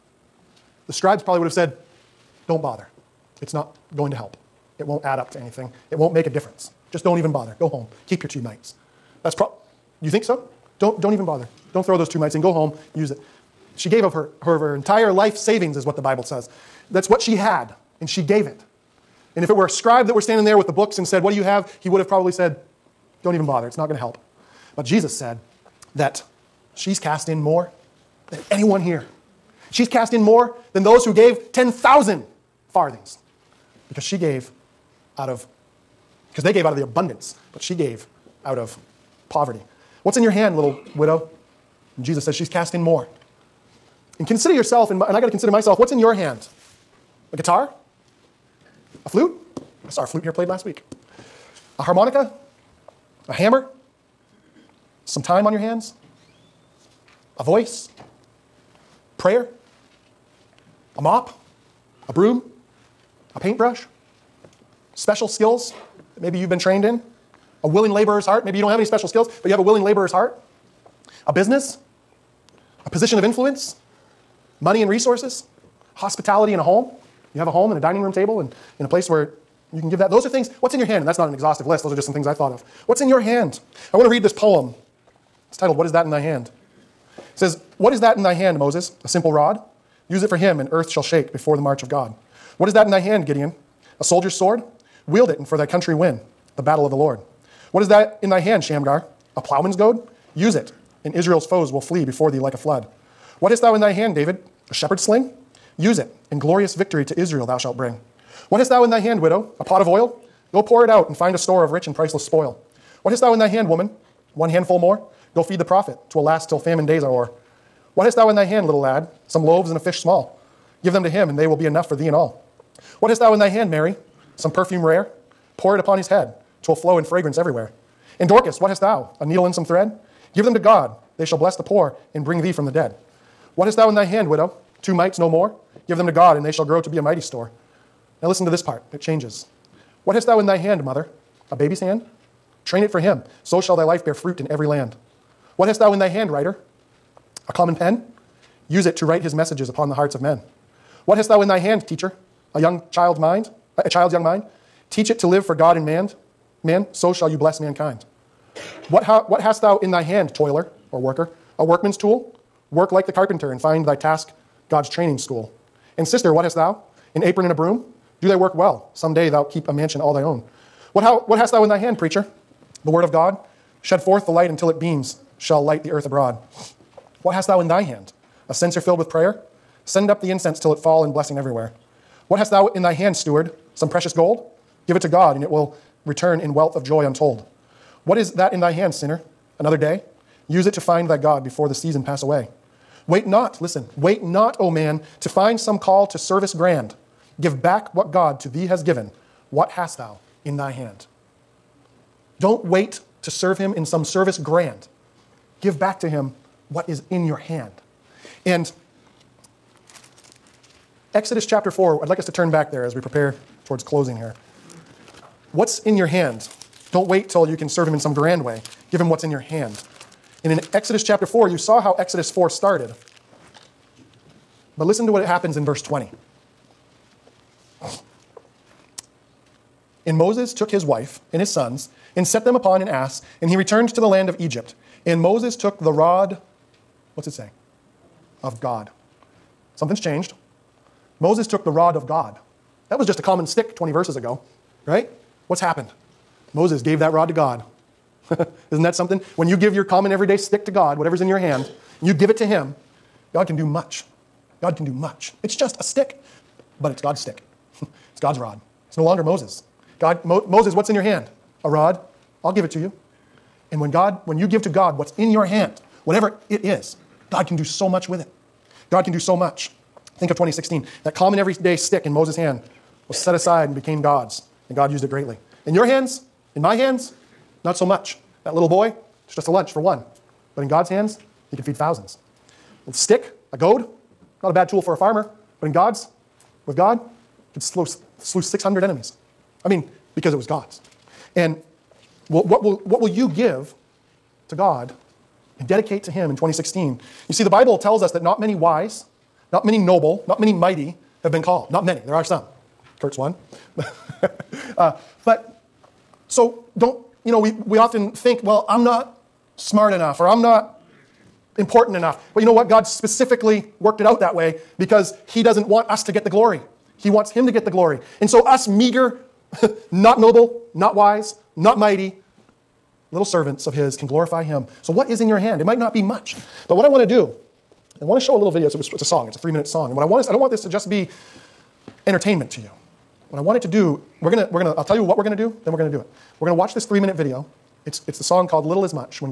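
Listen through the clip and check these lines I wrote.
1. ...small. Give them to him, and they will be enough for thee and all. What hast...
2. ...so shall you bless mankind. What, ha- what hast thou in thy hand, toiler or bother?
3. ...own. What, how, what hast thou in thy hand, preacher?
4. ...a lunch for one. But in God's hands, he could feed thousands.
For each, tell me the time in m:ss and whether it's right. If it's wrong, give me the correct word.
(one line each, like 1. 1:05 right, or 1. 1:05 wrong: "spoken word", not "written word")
1. 1:59 right
2. 2:36 wrong: "worker", not "bother"
3. 2:50 right
4. 4:39 right.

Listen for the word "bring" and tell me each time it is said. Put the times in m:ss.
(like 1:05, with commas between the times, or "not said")
1:47, 2:12.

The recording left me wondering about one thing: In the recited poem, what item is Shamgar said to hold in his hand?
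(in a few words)
A plowman's goad.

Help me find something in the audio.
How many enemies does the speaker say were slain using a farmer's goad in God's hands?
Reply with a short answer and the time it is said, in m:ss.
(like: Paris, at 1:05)
600, at 4:48.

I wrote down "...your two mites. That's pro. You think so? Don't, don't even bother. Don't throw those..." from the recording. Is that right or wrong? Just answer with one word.
right.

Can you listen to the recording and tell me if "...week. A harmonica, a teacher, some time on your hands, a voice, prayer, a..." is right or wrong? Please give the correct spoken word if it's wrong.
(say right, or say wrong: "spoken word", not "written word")
wrong: "hammer", not "teacher".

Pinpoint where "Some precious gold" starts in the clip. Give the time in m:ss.
3:03.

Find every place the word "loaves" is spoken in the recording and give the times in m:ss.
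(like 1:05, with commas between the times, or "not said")
1:59.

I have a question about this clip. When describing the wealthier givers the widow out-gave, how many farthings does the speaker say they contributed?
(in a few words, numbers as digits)
10,000.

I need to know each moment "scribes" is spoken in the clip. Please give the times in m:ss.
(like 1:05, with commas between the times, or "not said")
0:00, 0:19.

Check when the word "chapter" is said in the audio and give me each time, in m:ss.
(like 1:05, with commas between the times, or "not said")
3:31, 3:41.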